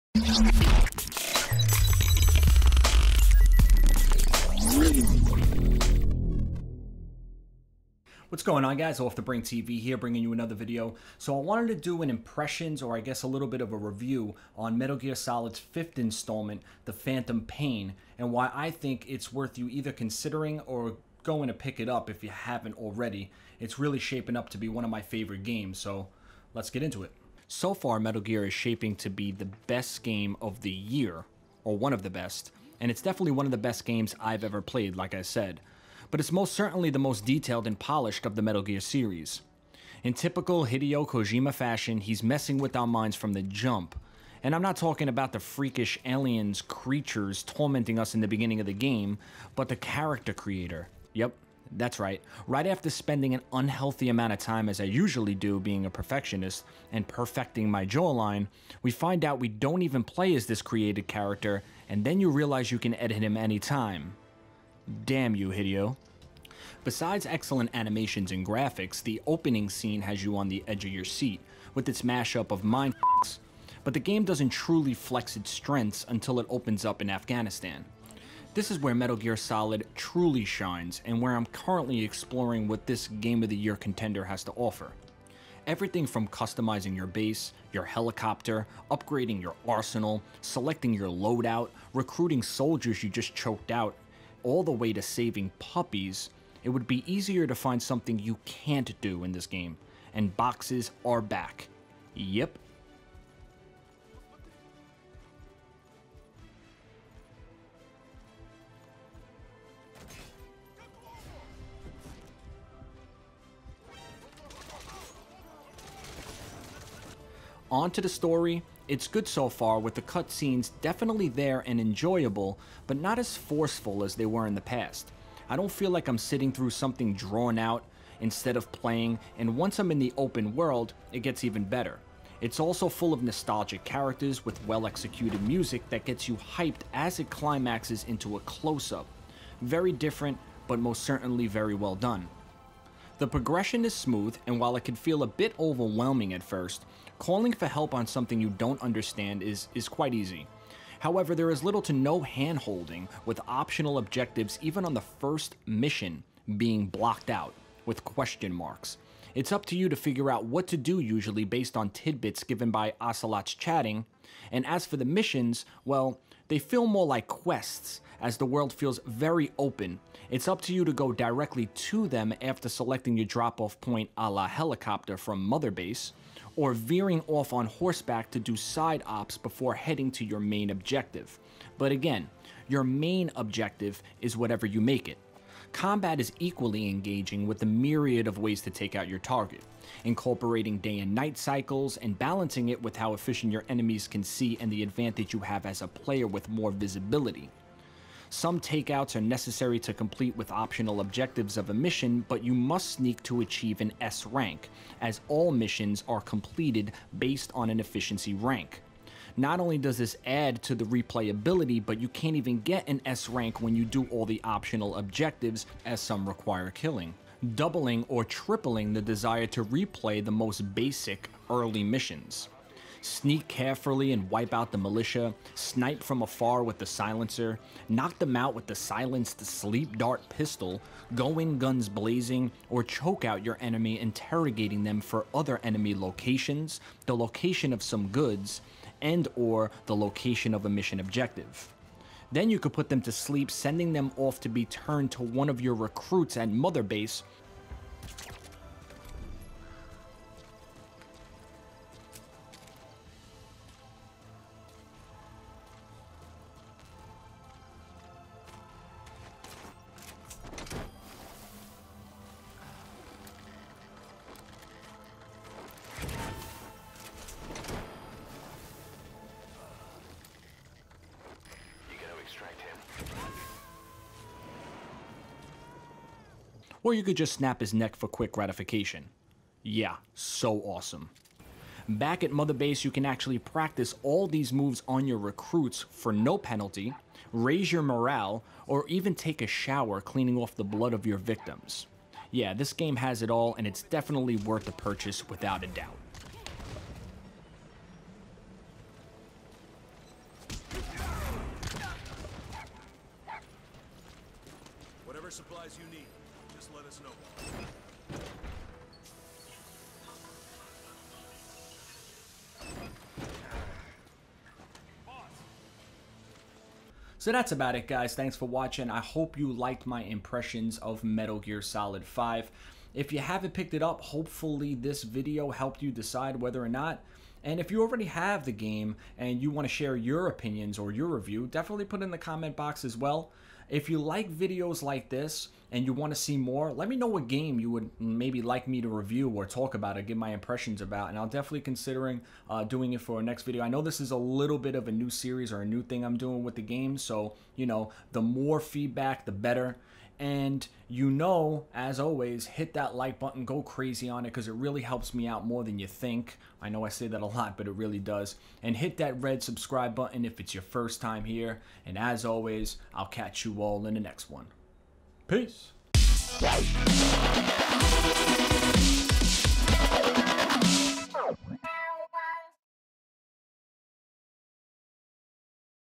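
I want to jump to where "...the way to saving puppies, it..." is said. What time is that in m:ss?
1:34.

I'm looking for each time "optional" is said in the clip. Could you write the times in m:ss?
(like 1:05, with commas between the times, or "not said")
2:33, 3:20, 3:34.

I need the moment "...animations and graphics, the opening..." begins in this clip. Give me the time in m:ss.
1:07.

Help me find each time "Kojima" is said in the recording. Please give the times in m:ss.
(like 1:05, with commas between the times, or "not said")
0:41.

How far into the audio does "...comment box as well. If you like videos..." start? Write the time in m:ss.
5:32.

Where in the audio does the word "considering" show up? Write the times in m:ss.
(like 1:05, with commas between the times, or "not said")
0:19, 5:41.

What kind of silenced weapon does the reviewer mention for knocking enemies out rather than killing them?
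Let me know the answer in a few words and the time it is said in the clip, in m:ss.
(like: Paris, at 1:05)
sleep dart pistol, at 3:49.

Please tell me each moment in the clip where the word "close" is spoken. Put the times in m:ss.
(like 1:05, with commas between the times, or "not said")
2:18.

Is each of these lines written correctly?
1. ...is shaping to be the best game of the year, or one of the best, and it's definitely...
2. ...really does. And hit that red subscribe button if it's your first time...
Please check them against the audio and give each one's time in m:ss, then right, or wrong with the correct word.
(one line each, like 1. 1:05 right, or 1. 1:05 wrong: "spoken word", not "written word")
1. 0:28 right
2. 5:57 right.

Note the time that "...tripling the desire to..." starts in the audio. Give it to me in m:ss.
3:38.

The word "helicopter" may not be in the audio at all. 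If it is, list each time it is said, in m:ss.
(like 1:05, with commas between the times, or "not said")
1:27, 2:54.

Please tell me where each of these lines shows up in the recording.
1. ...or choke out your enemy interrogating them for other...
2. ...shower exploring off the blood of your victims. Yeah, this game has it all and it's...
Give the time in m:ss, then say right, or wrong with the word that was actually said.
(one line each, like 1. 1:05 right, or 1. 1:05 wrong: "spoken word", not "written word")
1. 3:52 right
2. 4:49 wrong: "cleaning", not "exploring".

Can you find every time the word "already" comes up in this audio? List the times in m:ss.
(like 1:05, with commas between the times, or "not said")
0:22, 5:27.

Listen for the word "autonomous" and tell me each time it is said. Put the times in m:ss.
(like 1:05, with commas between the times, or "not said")
not said.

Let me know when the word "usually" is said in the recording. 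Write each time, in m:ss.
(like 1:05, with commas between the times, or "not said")
0:54, 2:40.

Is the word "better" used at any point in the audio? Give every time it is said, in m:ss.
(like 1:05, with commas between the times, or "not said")
2:11, 5:49.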